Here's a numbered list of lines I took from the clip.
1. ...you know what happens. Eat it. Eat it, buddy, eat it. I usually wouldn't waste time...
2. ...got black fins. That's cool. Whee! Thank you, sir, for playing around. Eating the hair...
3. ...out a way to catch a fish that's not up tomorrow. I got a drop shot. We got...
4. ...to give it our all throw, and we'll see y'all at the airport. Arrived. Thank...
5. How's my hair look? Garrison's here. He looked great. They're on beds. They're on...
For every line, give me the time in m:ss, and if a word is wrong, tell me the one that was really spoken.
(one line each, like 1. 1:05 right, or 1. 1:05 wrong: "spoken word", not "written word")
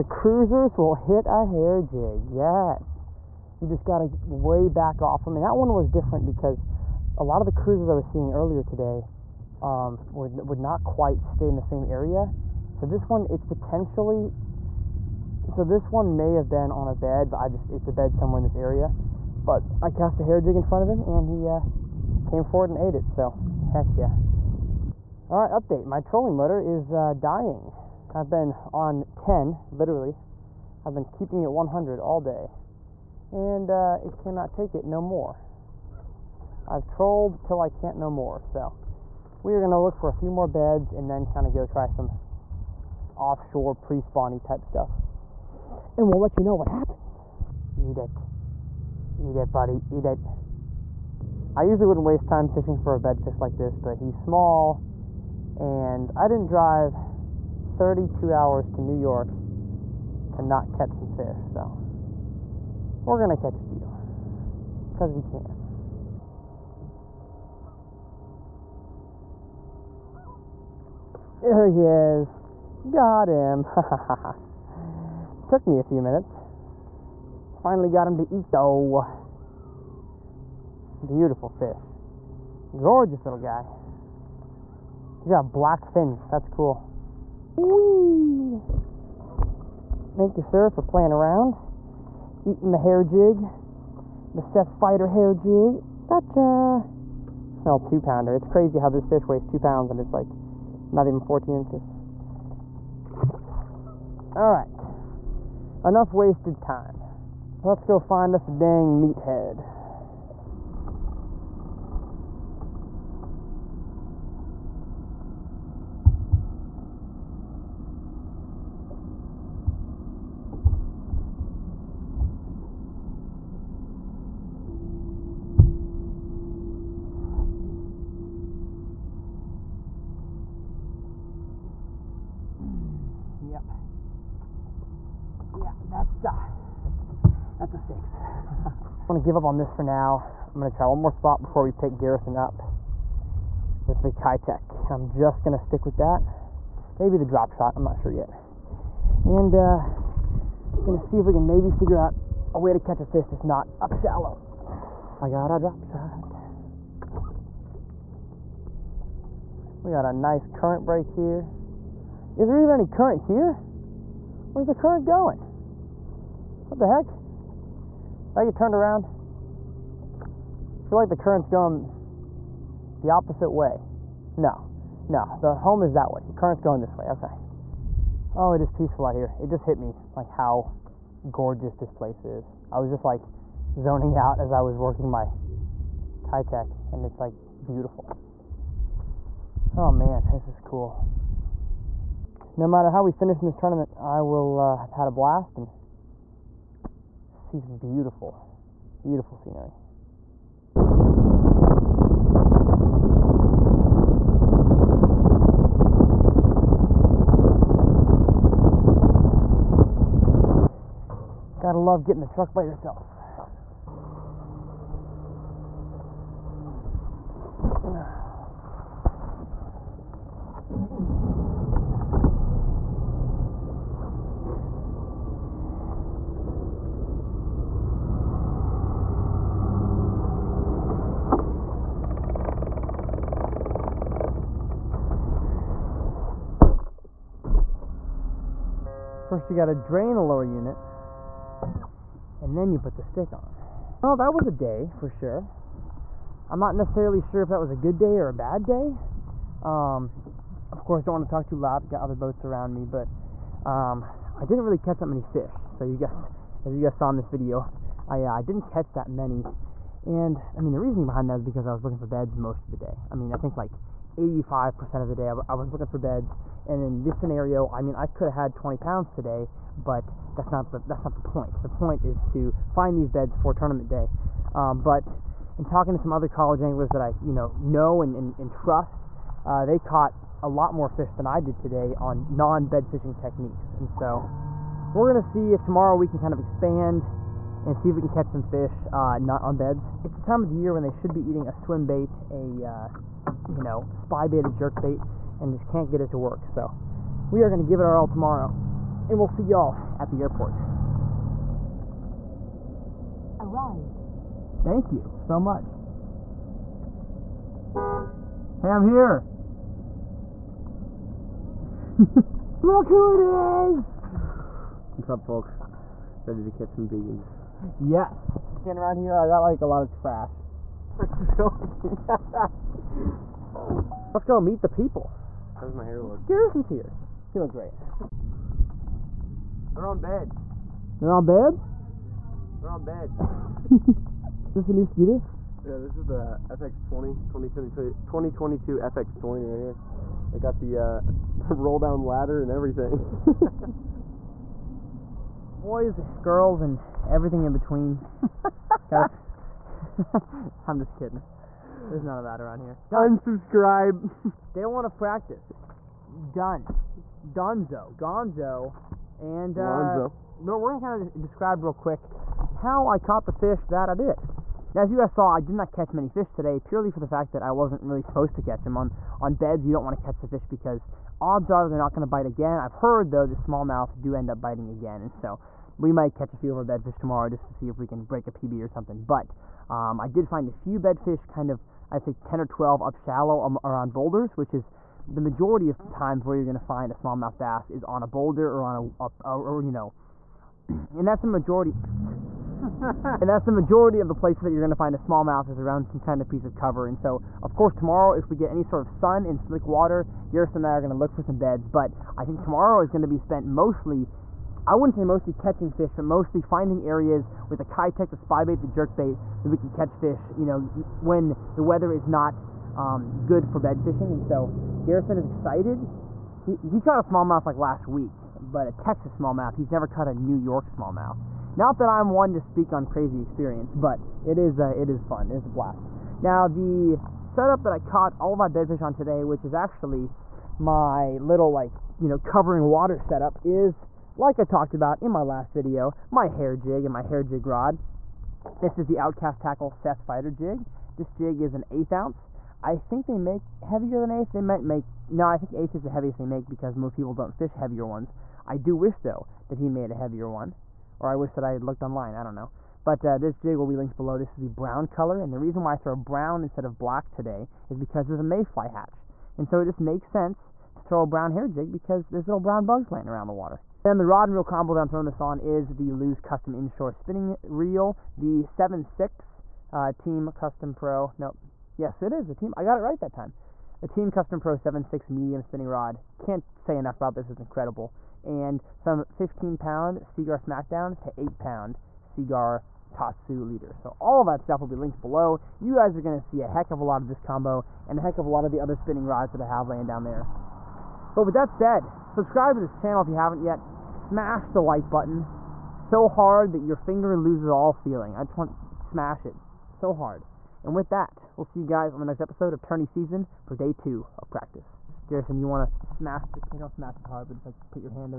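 1. 0:46 right
2. 1:25 right
3. 2:31 wrong: "shallow", not "tomorrow"
4. 4:57 wrong: "tomorrow", not "throw"
5. 5:25 right.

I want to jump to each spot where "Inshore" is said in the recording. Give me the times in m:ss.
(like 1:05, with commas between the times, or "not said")
7:46.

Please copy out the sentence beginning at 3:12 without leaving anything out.
No matter how we finish in this tournament, I will uh, have had a blast and see some beautiful, beautiful scenery.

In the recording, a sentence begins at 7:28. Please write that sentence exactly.
I do wish though that he made a heavier one or I wish that I had looked online, I don't know.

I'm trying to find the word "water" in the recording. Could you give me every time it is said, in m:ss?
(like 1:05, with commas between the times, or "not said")
6:39, 7:12, 7:43.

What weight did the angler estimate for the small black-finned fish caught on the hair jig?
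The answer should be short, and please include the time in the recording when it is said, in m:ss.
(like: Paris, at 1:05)
2 pounds, at 1:37.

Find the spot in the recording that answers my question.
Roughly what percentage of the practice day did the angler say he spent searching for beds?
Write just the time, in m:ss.
4:24.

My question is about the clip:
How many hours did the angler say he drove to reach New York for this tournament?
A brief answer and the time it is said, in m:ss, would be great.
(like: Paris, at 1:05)
32, at 0:57.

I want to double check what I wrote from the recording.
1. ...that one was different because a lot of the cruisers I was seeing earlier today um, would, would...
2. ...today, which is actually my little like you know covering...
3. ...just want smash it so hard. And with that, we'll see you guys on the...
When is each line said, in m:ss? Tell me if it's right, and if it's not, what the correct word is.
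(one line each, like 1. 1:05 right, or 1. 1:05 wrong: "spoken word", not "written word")
1. 0:05 right
2. 7:08 right
3. 8:18 right.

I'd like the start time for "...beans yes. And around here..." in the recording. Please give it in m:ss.
5:16.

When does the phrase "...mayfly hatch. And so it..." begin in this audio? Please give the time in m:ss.
7:38.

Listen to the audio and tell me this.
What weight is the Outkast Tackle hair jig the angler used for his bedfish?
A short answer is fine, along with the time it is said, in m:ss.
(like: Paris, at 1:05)
eighth ounce, at 7:21.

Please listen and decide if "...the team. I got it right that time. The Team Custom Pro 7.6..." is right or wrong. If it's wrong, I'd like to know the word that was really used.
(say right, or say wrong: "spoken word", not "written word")
right.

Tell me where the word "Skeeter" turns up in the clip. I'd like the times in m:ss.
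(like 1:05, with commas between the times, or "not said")
5:34.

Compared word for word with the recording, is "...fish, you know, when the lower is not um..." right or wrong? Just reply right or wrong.
wrong.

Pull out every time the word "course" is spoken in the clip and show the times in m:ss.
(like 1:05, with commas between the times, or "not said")
4:10, 6:37.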